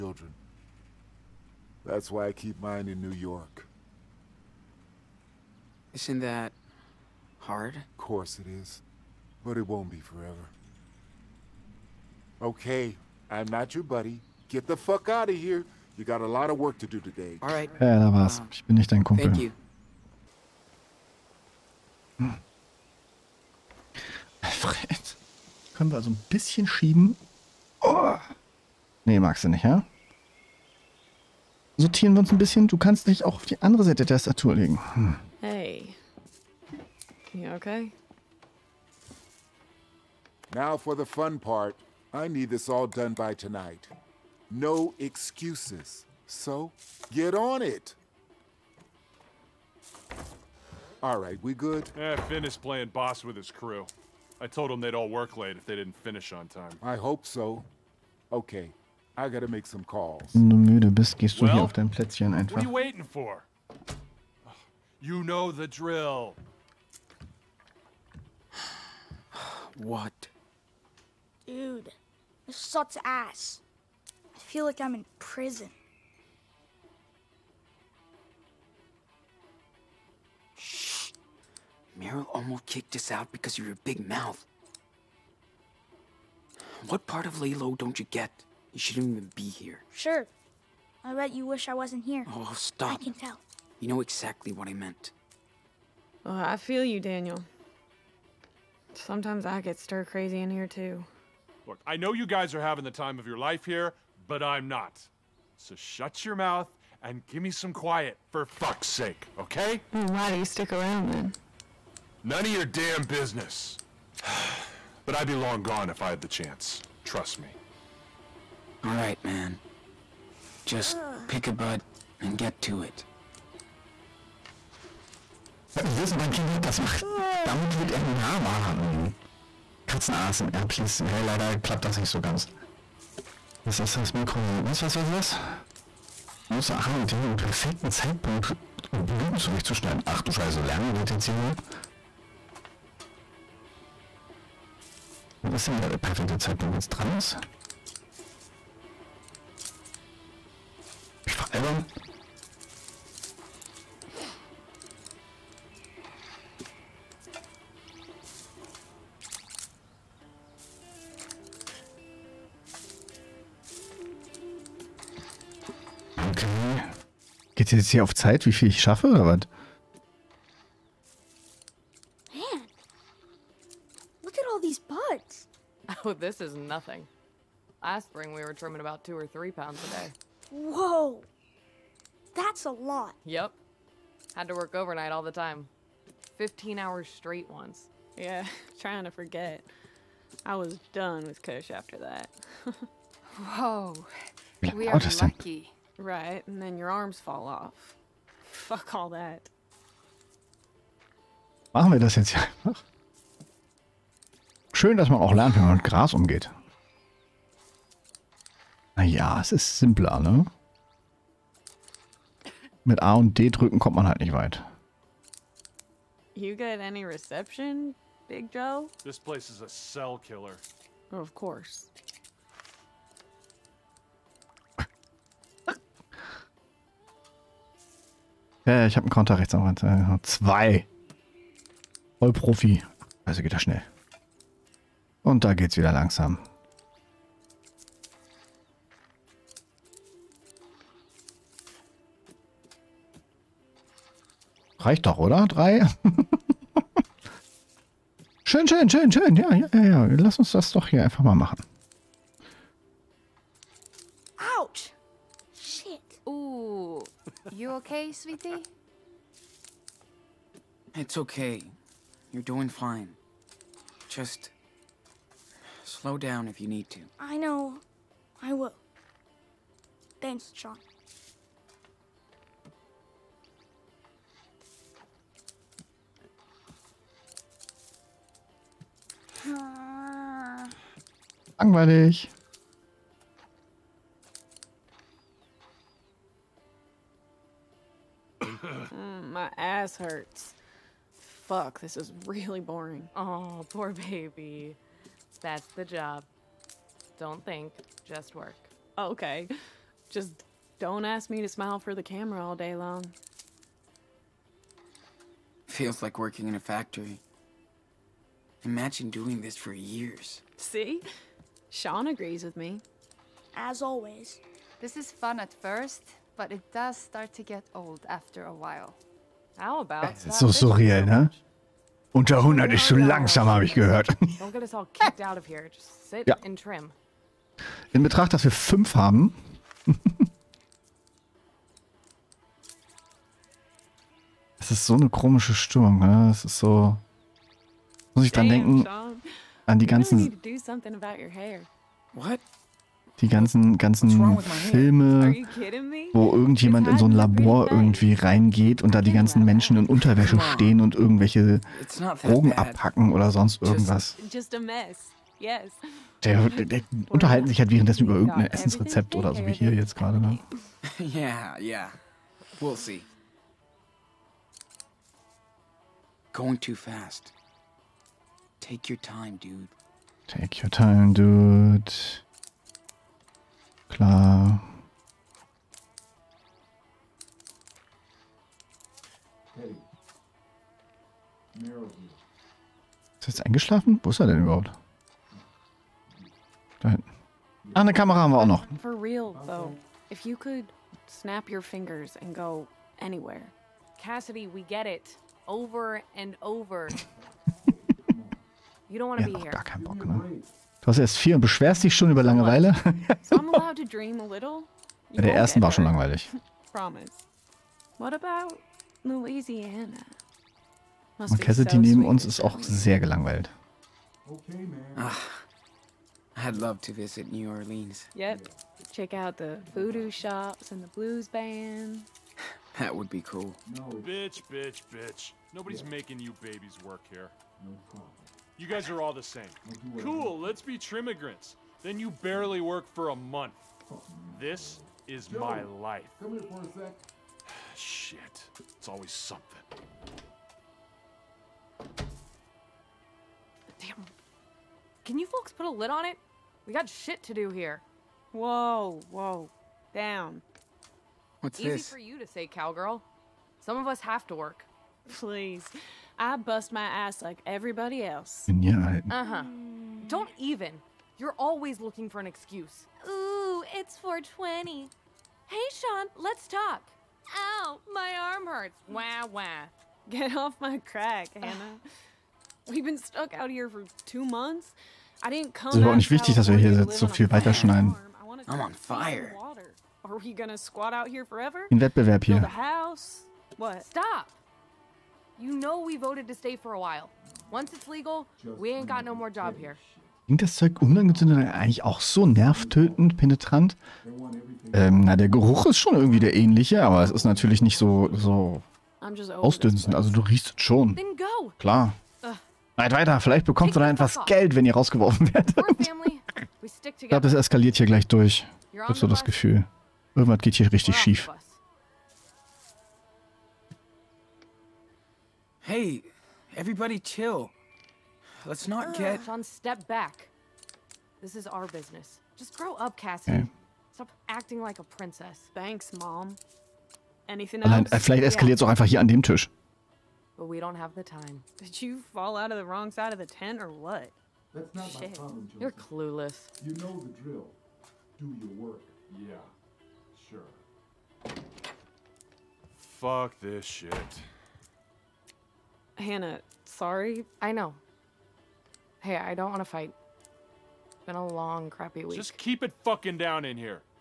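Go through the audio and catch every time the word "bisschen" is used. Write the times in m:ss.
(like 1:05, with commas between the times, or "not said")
0:26, 0:32.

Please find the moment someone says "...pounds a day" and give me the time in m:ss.
2:59.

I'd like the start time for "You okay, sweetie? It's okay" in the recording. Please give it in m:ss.
4:17.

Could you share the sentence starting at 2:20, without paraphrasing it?
Ach du Scheiße, lernen wir das jetzt hier so?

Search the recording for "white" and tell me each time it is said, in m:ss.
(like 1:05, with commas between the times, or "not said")
not said.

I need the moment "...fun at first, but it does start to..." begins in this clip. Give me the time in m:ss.
5:15.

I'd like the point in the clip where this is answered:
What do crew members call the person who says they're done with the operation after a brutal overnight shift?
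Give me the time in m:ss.
3:11.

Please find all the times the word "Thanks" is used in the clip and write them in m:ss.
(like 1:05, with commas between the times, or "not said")
0:19, 4:30, 8:45.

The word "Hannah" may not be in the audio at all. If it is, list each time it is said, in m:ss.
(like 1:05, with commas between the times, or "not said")
7:51, 9:05.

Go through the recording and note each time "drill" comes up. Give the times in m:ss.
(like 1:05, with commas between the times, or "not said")
1:05, 8:57.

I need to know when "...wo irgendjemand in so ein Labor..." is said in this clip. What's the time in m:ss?
5:46.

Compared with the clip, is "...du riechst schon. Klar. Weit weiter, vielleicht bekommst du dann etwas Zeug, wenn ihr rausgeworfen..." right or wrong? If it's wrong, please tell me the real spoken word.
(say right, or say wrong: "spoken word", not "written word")
wrong: "Geld", not "Zeug".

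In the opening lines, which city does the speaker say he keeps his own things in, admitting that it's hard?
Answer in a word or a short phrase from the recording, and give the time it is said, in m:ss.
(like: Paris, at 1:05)
New York, at 0:02.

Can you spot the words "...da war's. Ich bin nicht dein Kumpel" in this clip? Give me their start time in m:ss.
0:17.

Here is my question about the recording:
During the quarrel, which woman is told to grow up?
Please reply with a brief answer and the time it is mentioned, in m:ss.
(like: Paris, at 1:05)
Cassie, at 8:42.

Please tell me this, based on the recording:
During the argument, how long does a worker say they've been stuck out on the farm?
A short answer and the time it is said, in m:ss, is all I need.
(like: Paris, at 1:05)
two months, at 7:54.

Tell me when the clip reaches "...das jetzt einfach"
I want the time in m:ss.
3:21.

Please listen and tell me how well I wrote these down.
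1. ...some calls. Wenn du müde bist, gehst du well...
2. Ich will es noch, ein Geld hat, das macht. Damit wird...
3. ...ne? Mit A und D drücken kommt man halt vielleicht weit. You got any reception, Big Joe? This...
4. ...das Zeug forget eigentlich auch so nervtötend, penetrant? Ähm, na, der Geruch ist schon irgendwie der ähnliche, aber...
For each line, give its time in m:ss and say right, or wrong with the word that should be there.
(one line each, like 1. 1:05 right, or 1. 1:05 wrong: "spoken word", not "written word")
1. 0:59 right
2. 2:05 wrong: "Kind", not "Geld"
3. 3:30 wrong: "nicht", not "vielleicht"
4. 8:10 wrong: "unangezündet", not "forget".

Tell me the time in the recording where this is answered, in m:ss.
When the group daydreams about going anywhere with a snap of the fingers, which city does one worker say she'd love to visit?
6:57.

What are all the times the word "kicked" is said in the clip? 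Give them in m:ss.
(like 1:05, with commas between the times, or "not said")
1:22.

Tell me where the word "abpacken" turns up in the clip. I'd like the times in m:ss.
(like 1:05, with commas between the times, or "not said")
5:52.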